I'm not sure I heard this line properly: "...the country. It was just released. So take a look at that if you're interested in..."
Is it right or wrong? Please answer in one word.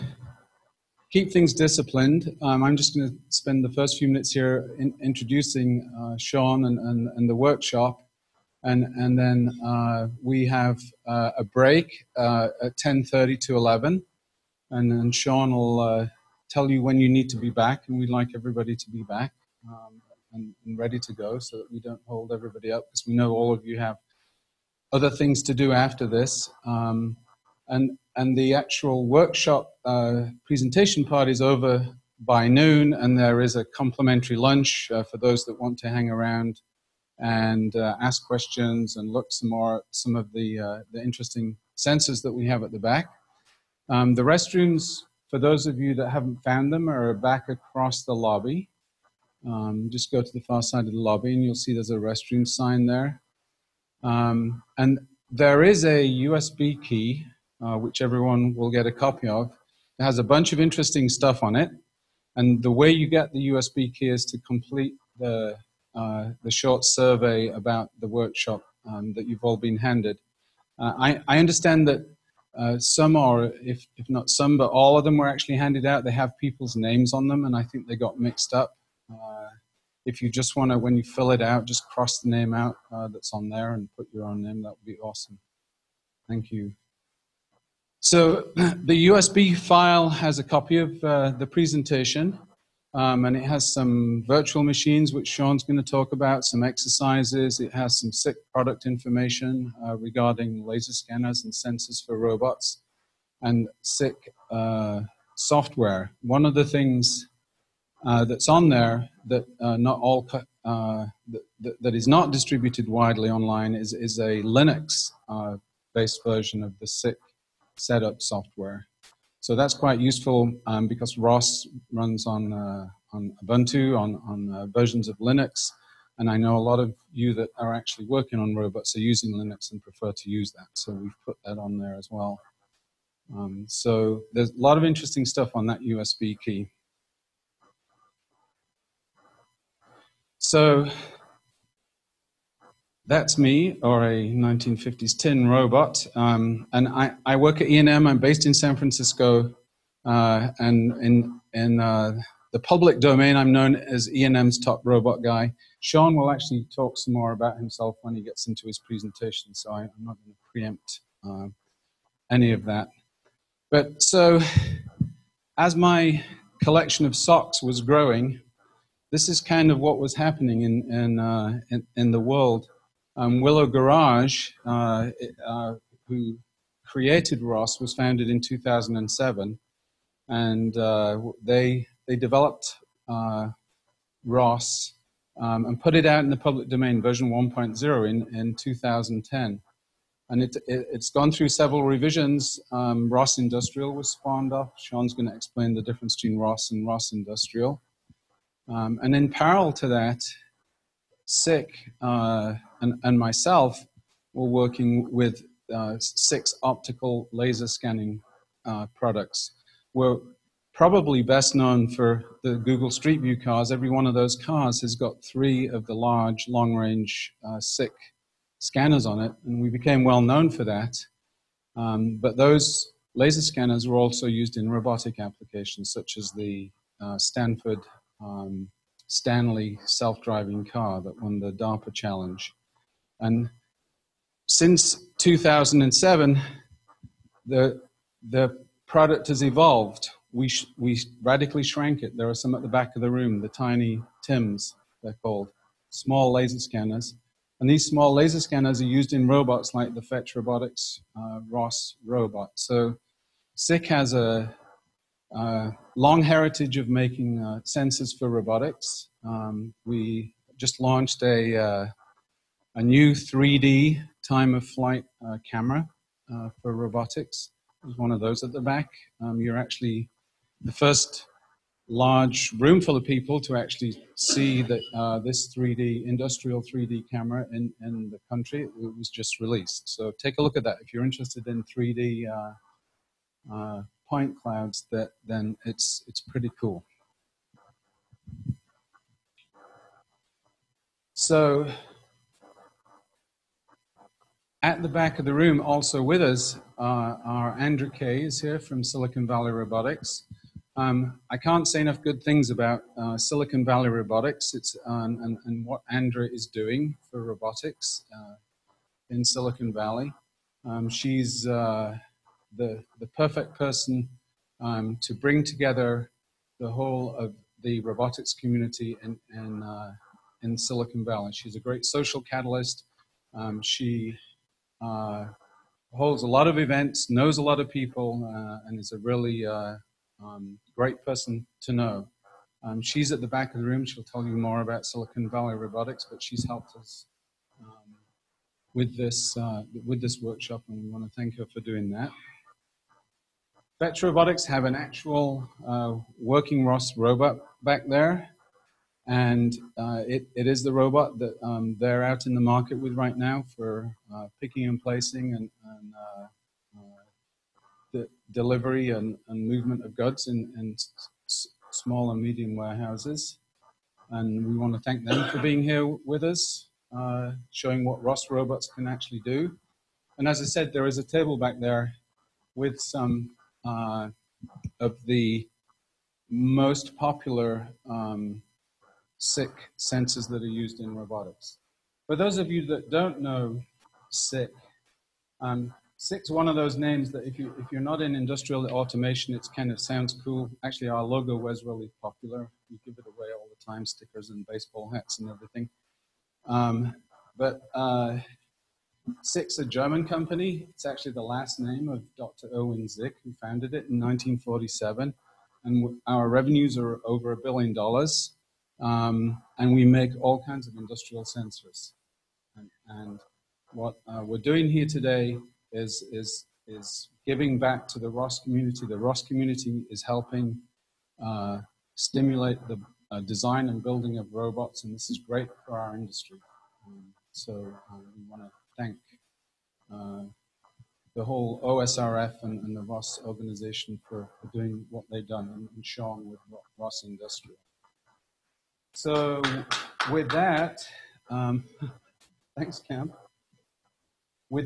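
right.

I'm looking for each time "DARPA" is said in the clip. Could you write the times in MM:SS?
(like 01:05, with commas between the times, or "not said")
03:51.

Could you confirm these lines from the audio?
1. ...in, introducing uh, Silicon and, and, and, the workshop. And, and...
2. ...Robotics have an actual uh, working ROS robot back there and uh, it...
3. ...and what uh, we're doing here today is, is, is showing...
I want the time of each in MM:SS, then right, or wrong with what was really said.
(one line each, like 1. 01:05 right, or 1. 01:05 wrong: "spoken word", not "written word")
1. 00:04 wrong: "Shaun", not "Silicon"
2. 05:44 right
3. 06:52 wrong: "giving", not "showing".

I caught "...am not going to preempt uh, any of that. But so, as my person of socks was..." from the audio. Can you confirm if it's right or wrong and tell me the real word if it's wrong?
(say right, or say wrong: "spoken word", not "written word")
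wrong: "collection", not "person".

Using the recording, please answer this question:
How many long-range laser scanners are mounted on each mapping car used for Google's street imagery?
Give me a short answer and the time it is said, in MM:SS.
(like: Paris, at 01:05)
3, at 03:35.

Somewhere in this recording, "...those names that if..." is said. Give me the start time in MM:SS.
06:26.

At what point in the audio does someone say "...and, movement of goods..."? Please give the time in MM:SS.
05:59.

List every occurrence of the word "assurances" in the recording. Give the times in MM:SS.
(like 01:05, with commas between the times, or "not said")
not said.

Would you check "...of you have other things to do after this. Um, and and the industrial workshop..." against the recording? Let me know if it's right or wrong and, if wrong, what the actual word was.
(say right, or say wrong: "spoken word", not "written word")
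wrong: "actual", not "industrial".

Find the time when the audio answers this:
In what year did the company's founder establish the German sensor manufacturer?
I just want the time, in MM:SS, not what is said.
06:43.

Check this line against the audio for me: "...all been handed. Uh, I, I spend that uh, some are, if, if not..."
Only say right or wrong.
wrong.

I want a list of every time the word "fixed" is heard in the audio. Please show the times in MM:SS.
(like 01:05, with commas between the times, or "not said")
not said.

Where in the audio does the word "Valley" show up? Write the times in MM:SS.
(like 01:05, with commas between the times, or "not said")
04:59, 05:03, 05:09, 05:21, 05:35.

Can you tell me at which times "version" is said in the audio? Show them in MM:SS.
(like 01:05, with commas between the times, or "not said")
01:56, 02:04, 03:07.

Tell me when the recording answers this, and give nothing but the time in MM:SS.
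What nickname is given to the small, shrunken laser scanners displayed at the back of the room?
04:03.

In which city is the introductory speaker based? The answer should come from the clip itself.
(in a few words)
San Francisco.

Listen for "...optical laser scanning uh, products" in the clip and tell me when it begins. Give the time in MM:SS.
03:26.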